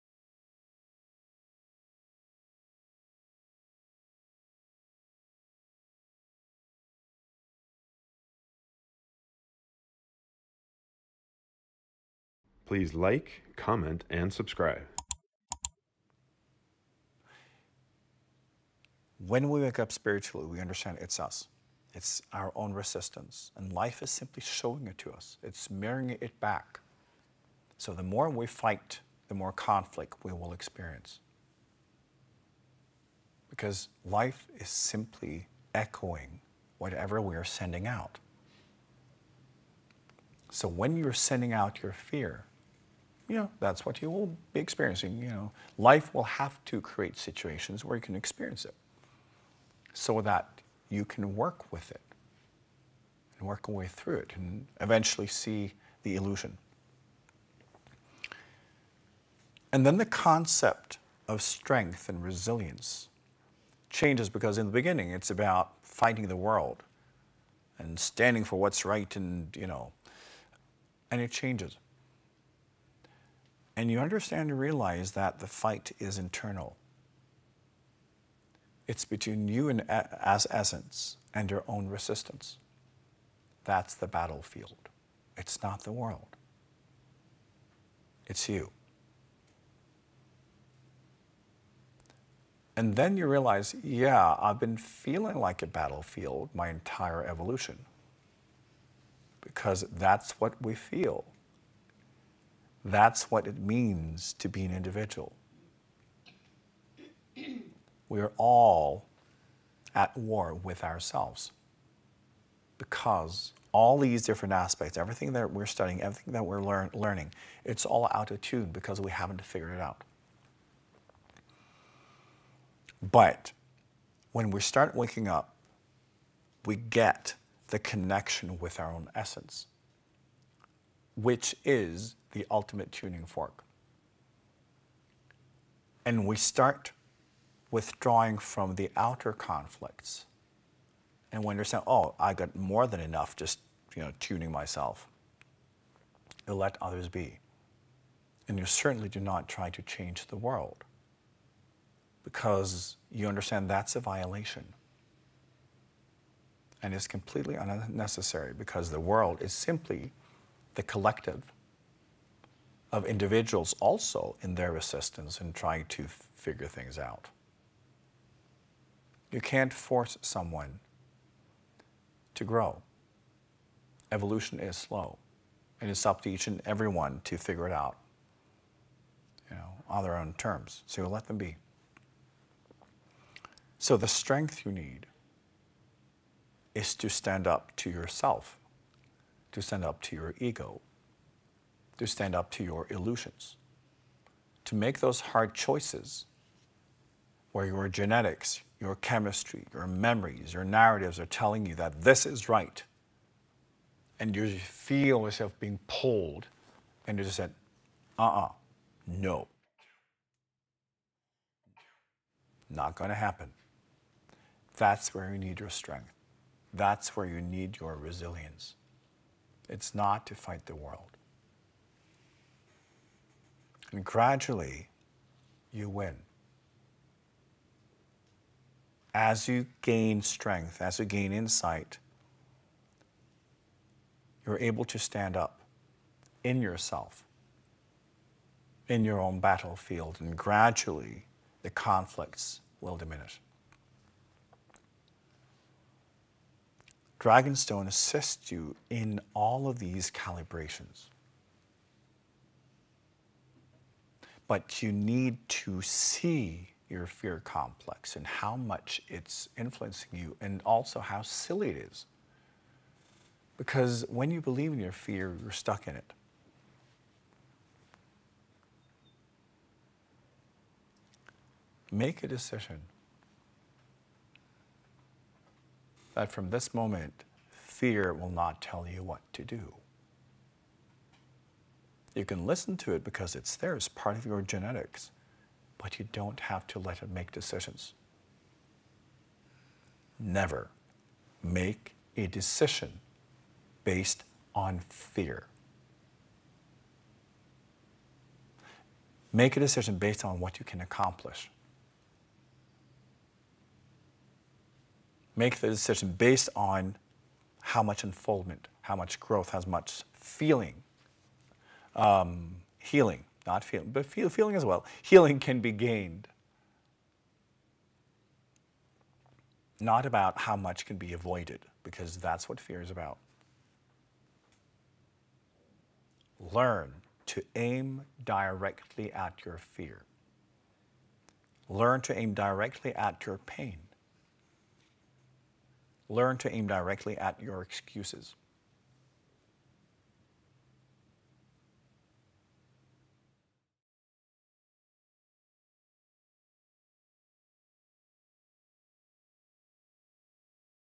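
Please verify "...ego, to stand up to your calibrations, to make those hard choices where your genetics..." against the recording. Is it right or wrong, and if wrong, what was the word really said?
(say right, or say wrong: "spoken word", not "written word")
wrong: "illusions", not "calibrations".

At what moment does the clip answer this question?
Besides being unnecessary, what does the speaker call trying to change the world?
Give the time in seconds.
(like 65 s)
153 s.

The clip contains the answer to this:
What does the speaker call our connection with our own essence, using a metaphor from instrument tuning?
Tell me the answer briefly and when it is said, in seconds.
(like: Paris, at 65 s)
the ultimate tuning fork, at 132 s.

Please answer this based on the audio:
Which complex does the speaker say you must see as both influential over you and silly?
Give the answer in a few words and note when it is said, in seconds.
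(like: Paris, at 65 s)
fear complex, at 257 s.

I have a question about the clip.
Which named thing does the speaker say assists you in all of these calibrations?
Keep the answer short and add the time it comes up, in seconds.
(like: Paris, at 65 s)
Dragonstone, at 247 s.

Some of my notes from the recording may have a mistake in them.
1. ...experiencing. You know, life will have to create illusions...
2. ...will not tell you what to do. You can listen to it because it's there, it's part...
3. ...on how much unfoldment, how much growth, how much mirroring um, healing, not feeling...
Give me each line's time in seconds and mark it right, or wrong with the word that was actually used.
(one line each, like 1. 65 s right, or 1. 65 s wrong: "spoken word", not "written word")
1. 44 s wrong: "situations", not "illusions"
2. 278 s right
3. 306 s wrong: "feeling", not "mirroring".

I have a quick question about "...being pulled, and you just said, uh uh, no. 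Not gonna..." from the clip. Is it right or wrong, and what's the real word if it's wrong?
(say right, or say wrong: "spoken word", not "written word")
right.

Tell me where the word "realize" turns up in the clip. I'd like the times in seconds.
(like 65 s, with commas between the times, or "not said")
74 s, 93 s.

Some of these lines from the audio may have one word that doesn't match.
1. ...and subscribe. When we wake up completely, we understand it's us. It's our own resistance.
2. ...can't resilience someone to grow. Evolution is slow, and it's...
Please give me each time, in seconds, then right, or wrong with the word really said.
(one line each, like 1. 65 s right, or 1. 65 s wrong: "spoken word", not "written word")
1. 14 s wrong: "spiritually", not "completely"
2. 169 s wrong: "force", not "resilience".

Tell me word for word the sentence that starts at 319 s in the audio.
Not about how much can be avoided, because that's what fear is about.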